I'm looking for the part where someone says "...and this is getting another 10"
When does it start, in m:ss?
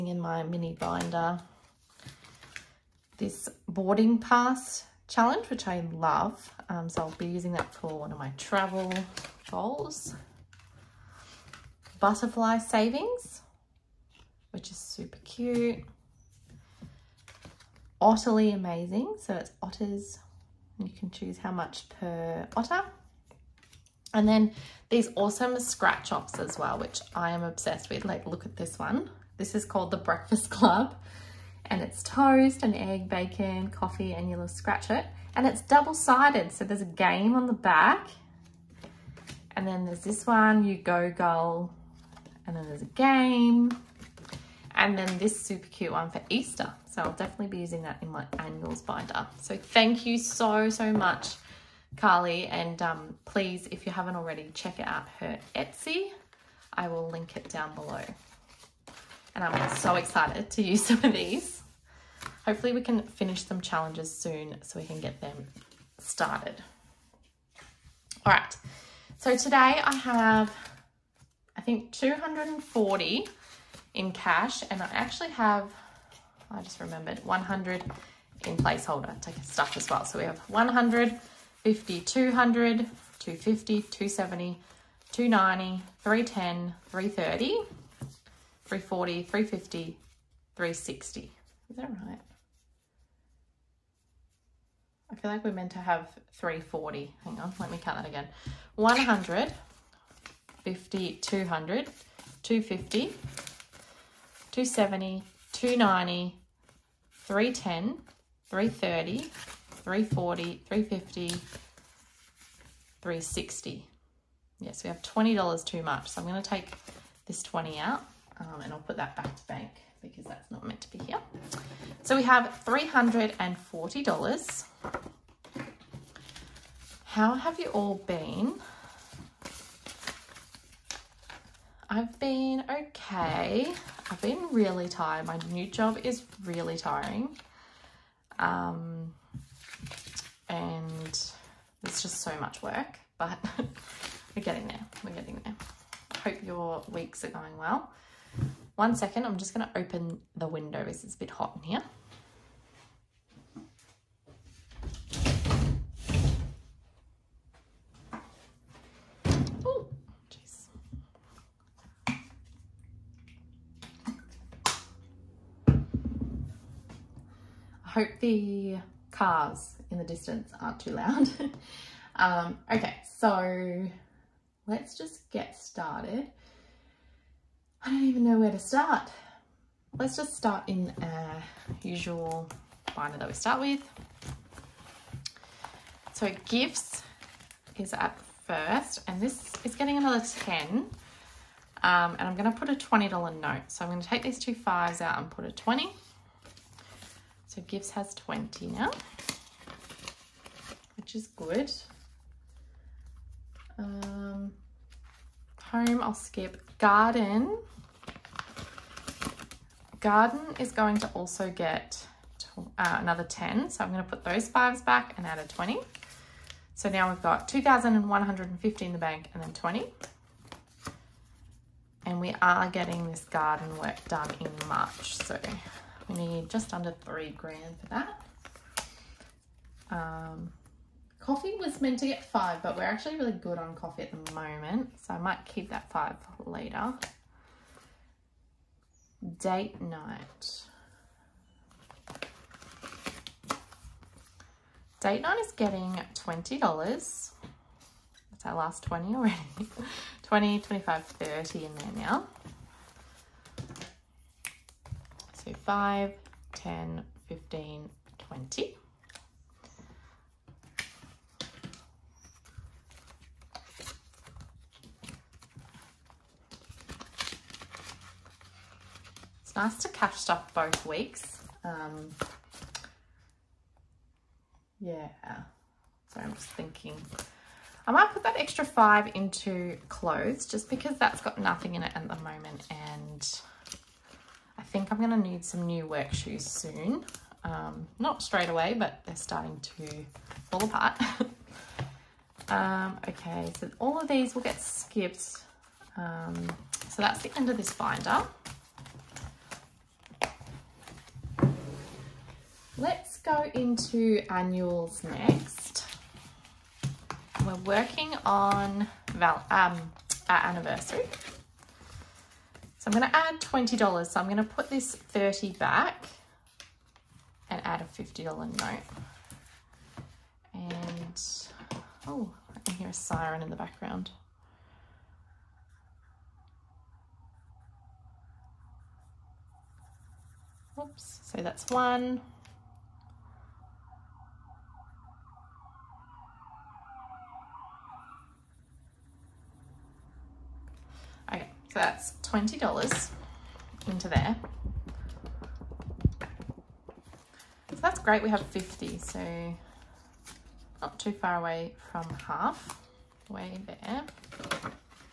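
3:09.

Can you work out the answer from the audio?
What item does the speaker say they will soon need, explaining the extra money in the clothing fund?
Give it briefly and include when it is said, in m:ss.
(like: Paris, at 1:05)
work shoes, at 4:45.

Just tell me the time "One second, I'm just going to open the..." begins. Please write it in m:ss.
2:28.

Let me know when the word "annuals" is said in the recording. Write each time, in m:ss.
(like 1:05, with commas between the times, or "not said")
0:48, 5:04.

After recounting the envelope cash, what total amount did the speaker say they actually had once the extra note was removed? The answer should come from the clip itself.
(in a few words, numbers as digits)
$340.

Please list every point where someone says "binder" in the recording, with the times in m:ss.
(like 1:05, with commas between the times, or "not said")
0:00, 0:48, 3:02, 4:57.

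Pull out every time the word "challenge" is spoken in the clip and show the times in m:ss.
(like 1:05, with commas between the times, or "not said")
0:05, 1:03.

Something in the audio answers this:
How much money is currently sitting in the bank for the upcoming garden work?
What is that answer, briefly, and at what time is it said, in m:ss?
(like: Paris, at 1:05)
2,150, at 3:37.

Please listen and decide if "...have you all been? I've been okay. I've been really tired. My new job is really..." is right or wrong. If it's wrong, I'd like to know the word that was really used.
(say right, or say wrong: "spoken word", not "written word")
right.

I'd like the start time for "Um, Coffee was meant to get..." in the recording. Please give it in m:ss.
3:49.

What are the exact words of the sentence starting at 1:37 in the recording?
Hang on, let me count that again.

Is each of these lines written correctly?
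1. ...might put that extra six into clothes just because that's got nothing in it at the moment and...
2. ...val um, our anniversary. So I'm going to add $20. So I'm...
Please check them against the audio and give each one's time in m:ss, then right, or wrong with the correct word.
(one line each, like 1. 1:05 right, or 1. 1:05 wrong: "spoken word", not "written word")
1. 4:37 wrong: "five", not "six"
2. 5:09 right.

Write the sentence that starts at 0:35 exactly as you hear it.
And it's double-sided, so there's a game on the back.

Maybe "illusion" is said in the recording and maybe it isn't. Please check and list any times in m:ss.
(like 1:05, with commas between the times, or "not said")
not said.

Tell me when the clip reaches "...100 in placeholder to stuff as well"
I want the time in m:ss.
1:17.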